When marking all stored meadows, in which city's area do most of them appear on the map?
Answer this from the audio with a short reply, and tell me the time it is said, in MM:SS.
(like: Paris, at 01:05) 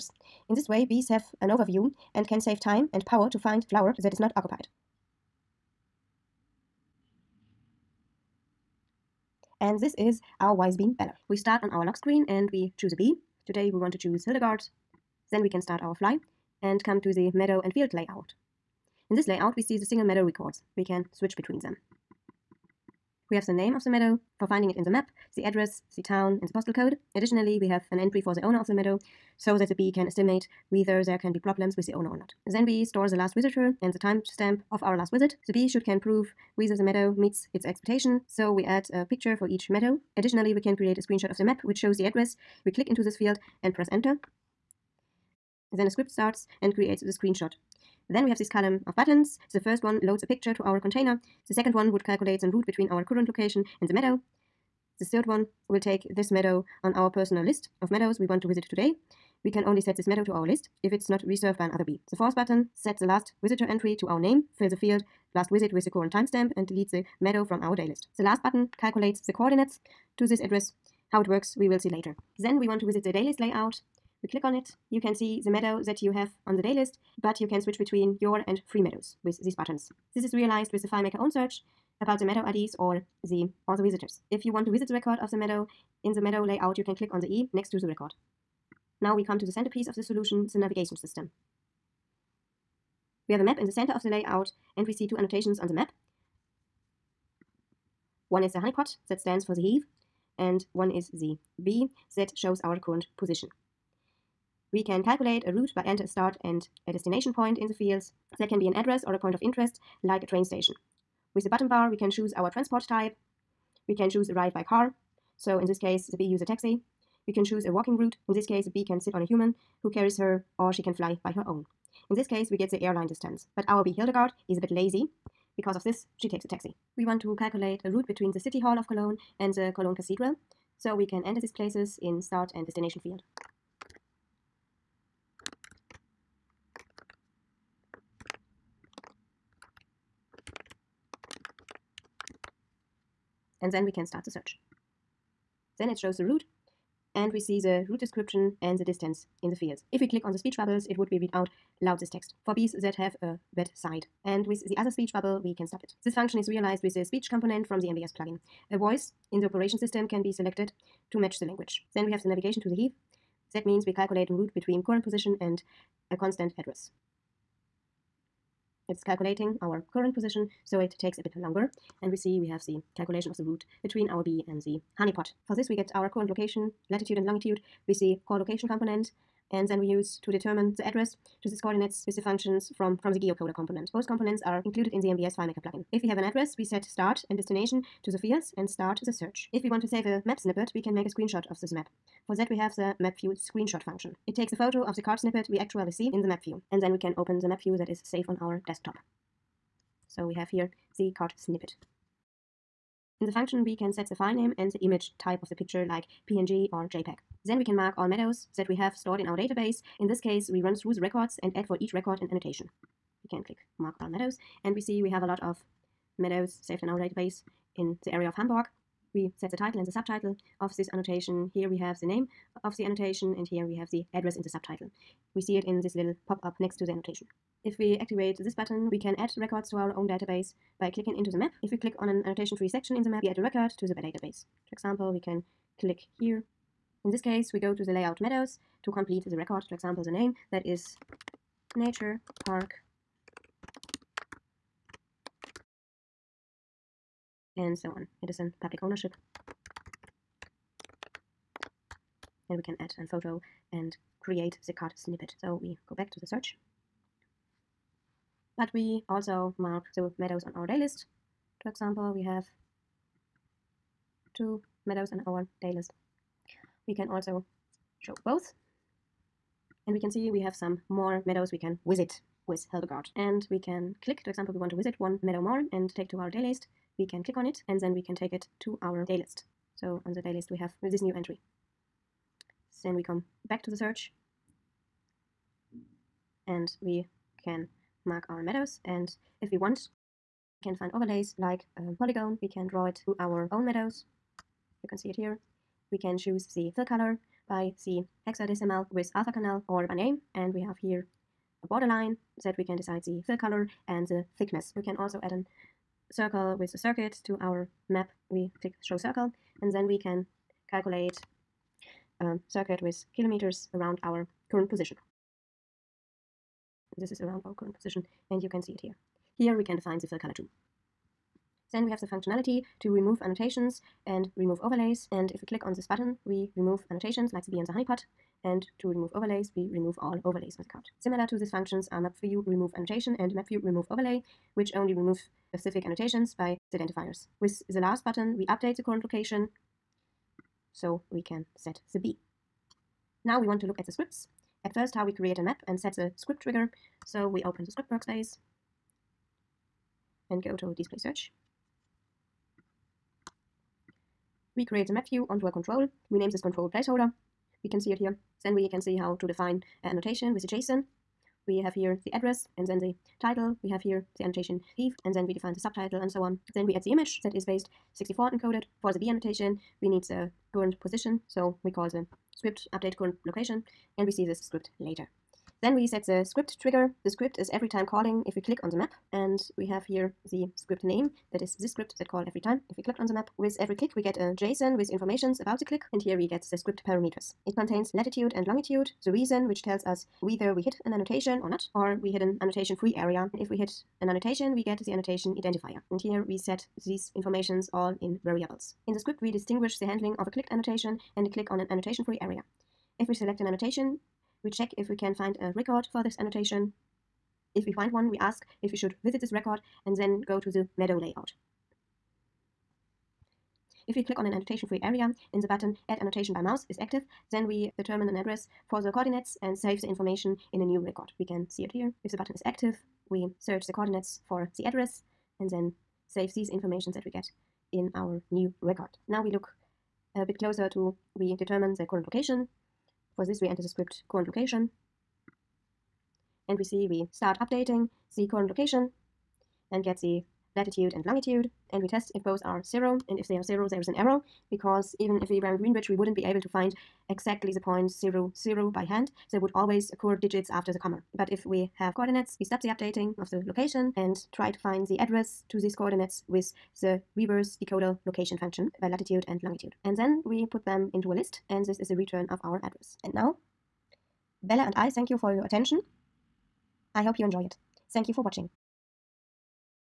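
Hamburg, at 03:38.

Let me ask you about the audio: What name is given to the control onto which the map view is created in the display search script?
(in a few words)
placeholder.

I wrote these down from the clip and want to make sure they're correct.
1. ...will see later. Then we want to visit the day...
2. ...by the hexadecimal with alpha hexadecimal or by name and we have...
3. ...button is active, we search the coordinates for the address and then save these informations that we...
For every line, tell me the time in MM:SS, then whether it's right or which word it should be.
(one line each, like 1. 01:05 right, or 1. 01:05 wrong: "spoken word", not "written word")
1. 01:11 right
2. 04:57 wrong: "canal", not "hexadecimal"
3. 07:02 right.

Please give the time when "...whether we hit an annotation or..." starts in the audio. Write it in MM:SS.
06:30.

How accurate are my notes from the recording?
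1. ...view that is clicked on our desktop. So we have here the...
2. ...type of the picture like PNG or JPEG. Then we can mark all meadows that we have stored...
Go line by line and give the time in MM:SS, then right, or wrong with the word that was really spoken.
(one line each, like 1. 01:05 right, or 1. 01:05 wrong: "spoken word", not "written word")
1. 03:17 wrong: "saved", not "clicked"
2. 03:25 right.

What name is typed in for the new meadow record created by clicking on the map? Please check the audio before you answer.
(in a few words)
nature park.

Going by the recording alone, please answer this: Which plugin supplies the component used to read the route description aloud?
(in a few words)
MBS plugin.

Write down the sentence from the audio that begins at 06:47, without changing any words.
If we find one, we ask if we should visit this record and then go to the meadow layout.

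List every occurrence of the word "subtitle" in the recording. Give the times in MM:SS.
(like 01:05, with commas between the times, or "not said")
03:39, 03:44, 06:05.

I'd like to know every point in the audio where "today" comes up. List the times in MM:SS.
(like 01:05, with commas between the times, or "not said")
00:13, 00:58.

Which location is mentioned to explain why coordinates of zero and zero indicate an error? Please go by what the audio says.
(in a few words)
Greenwich.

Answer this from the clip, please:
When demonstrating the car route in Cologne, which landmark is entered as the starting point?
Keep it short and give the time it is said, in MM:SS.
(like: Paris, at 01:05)
City Hall of Cologne, at 02:08.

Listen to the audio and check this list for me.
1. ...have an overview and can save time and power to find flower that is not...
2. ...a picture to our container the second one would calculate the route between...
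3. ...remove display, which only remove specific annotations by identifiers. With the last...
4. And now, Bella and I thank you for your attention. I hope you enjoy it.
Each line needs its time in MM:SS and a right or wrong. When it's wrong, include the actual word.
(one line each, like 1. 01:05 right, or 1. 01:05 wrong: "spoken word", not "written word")
1. 00:01 right
2. 00:50 right
3. 05:33 wrong: "overlay", not "display"
4. 07:43 right.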